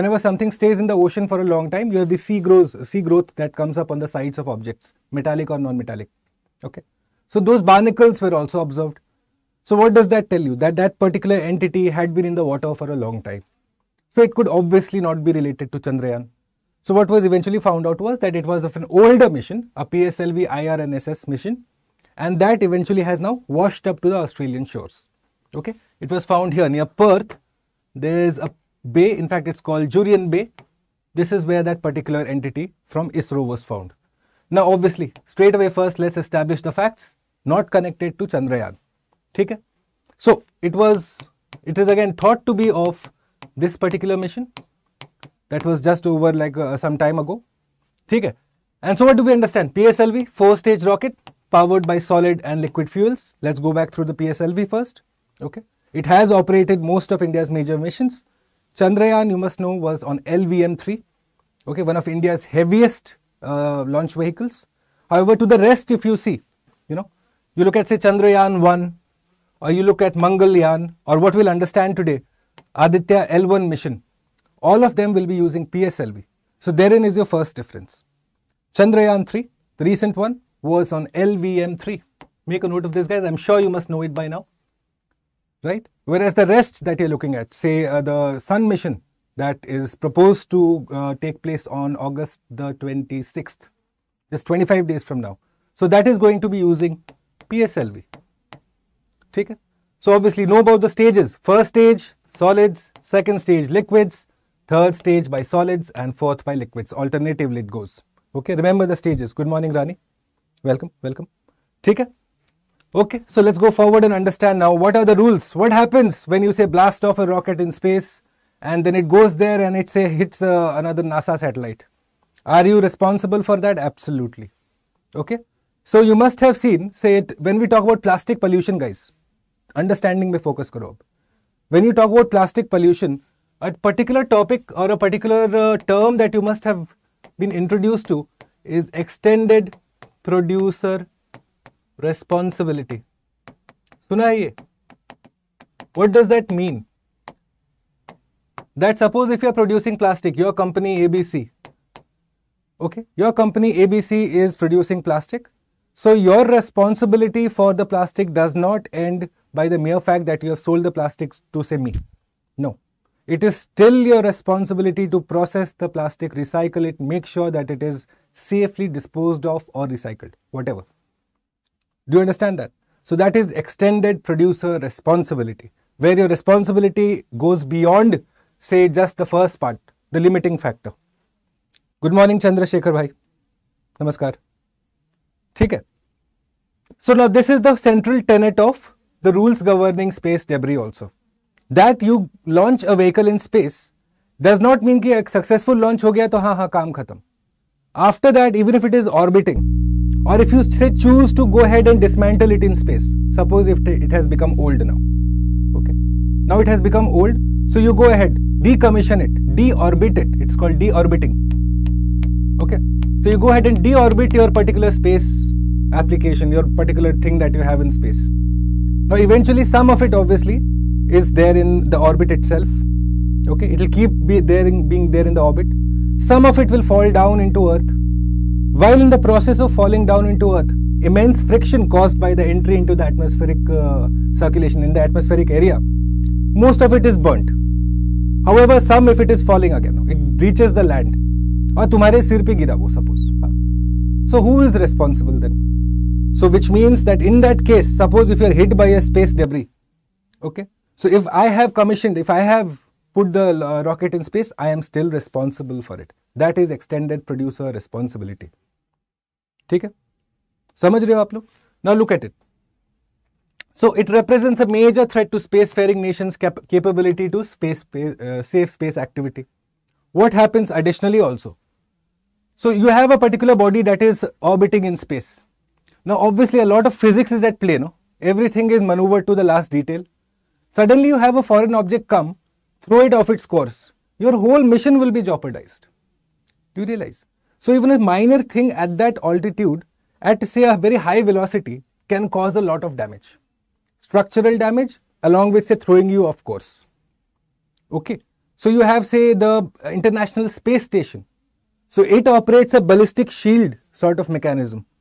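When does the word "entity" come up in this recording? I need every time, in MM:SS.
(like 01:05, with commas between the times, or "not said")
00:11, 00:32.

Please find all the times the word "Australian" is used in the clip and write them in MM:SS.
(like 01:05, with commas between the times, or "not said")
00:24.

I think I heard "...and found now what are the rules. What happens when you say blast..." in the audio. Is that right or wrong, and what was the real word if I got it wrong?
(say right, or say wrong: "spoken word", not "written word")
wrong: "understand", not "found".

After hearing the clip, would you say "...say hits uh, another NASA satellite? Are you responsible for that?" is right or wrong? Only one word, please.
right.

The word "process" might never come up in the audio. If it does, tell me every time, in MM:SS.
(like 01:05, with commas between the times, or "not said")
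02:45, 03:49.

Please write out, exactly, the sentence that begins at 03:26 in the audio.
Now it has become old, so you go ahead, decommission it, deorbit it.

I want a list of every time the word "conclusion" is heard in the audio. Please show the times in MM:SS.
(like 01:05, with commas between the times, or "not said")
not said.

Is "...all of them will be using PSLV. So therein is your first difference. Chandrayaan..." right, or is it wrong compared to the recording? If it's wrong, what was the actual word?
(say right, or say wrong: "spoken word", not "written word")
right.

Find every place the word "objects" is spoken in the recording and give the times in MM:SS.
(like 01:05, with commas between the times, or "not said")
00:04, 04:41.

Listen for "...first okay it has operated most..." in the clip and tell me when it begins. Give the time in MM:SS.
00:54.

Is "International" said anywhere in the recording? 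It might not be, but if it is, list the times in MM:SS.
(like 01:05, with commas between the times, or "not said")
04:59.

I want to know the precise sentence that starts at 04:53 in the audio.
Structural damage along with say throwing you off course.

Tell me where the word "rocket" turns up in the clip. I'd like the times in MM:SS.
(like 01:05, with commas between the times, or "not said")
00:50, 01:57, 04:13.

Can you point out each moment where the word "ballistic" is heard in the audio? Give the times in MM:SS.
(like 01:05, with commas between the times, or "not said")
05:02.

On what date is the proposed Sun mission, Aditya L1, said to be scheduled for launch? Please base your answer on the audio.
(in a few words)
August 26.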